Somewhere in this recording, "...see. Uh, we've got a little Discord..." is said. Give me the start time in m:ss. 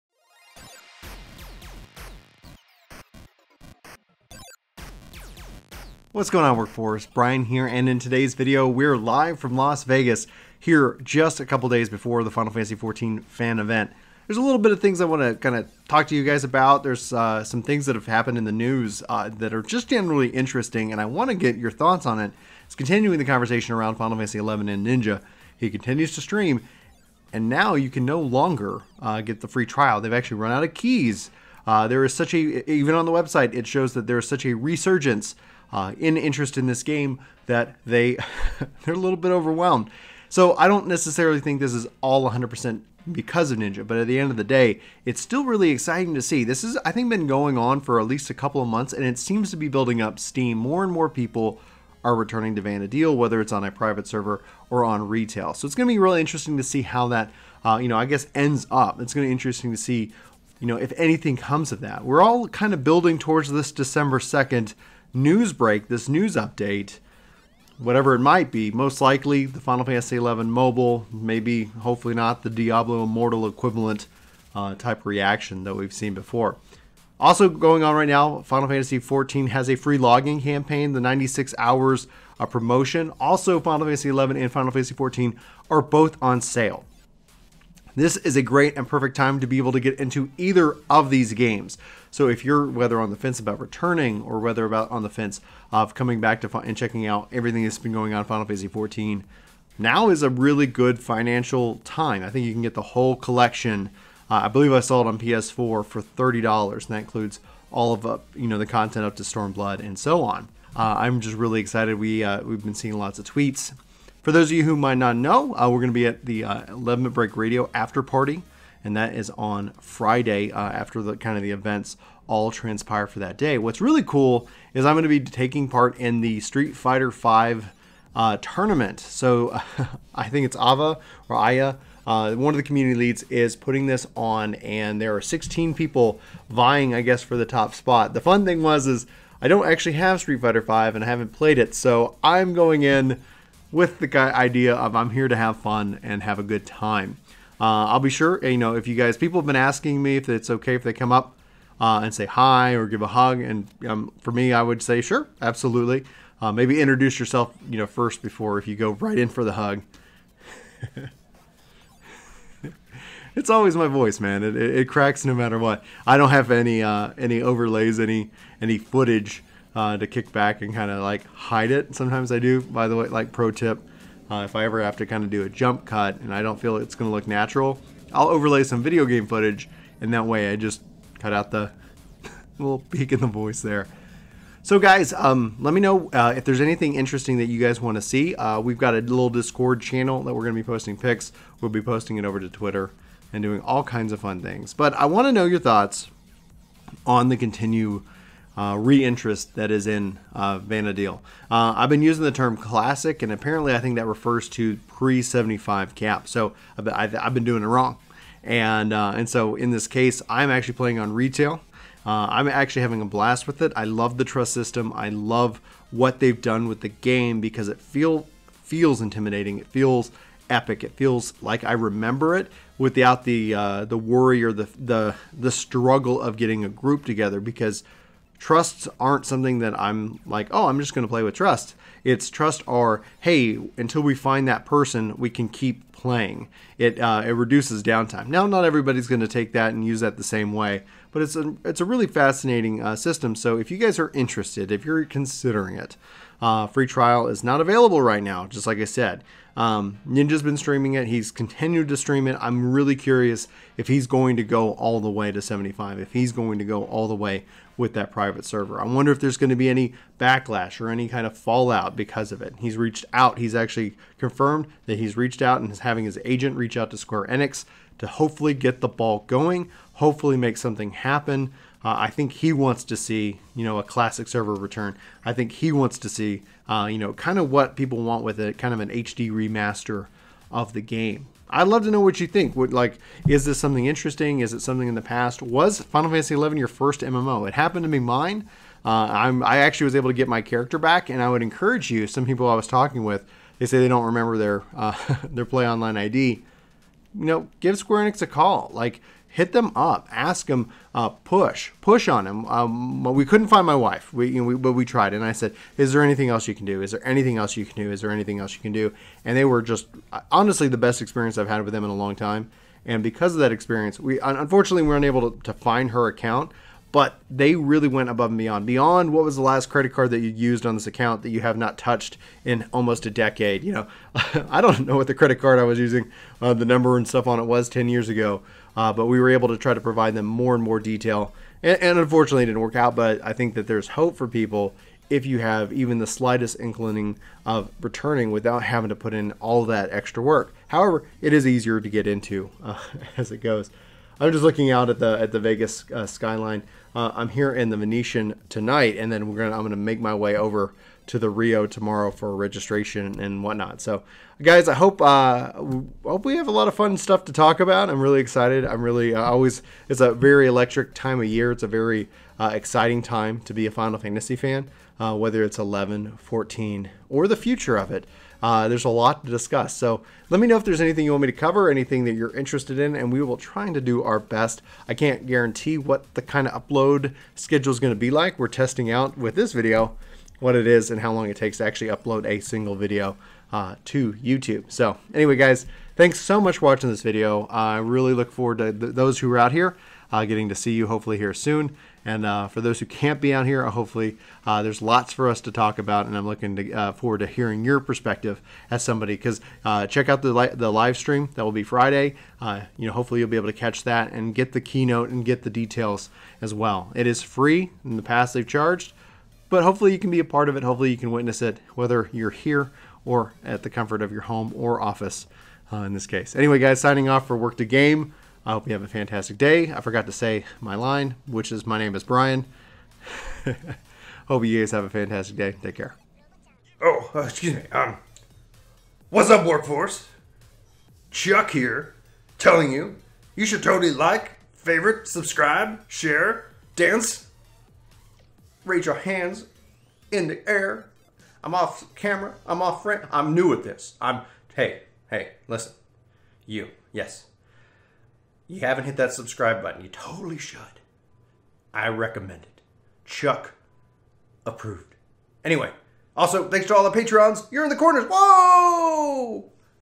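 3:08.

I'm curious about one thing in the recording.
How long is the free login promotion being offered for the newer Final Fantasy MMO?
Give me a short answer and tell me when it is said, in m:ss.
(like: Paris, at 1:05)
96 hours, at 1:21.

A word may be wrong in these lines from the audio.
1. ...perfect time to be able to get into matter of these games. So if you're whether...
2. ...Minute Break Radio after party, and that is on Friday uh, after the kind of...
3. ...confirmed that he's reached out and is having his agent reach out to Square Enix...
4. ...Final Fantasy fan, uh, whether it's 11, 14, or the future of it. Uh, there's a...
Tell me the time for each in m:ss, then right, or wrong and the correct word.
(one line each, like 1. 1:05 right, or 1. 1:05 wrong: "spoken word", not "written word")
1. 1:28 wrong: "either", not "matter"
2. 1:57 right
3. 4:24 right
4. 6:03 right.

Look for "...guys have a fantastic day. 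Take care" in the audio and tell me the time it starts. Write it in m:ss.
7:04.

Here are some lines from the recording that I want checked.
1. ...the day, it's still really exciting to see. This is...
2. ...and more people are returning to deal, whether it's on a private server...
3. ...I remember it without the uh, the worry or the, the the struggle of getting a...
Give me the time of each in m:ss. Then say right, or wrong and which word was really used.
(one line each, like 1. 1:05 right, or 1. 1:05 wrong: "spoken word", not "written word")
1. 0:44 right
2. 0:50 right
3. 3:41 right.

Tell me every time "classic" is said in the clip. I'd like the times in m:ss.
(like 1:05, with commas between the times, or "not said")
3:22, 4:33.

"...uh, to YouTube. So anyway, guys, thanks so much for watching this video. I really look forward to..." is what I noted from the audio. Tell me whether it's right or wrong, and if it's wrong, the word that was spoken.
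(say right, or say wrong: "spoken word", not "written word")
right.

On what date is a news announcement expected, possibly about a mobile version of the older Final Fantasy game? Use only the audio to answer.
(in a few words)
December 2nd.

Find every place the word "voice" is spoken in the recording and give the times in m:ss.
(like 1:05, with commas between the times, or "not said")
2:43, 3:03.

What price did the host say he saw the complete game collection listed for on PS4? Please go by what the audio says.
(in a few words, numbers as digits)
$30.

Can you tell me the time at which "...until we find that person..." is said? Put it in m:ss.
3:53.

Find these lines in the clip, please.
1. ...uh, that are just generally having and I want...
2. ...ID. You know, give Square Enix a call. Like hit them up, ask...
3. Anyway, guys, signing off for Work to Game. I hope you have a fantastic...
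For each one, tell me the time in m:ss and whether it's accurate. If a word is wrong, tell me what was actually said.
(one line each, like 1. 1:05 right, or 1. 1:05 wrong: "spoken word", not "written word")
1. 0:19 wrong: "interesting", not "having"
2. 4:55 right
3. 6:56 right.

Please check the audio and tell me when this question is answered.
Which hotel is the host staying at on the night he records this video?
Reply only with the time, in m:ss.
5:47.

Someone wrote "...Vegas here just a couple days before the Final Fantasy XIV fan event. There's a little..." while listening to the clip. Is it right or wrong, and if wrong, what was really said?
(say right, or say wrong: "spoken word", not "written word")
right.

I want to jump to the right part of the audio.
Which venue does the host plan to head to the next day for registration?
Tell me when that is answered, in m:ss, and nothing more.
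5:51.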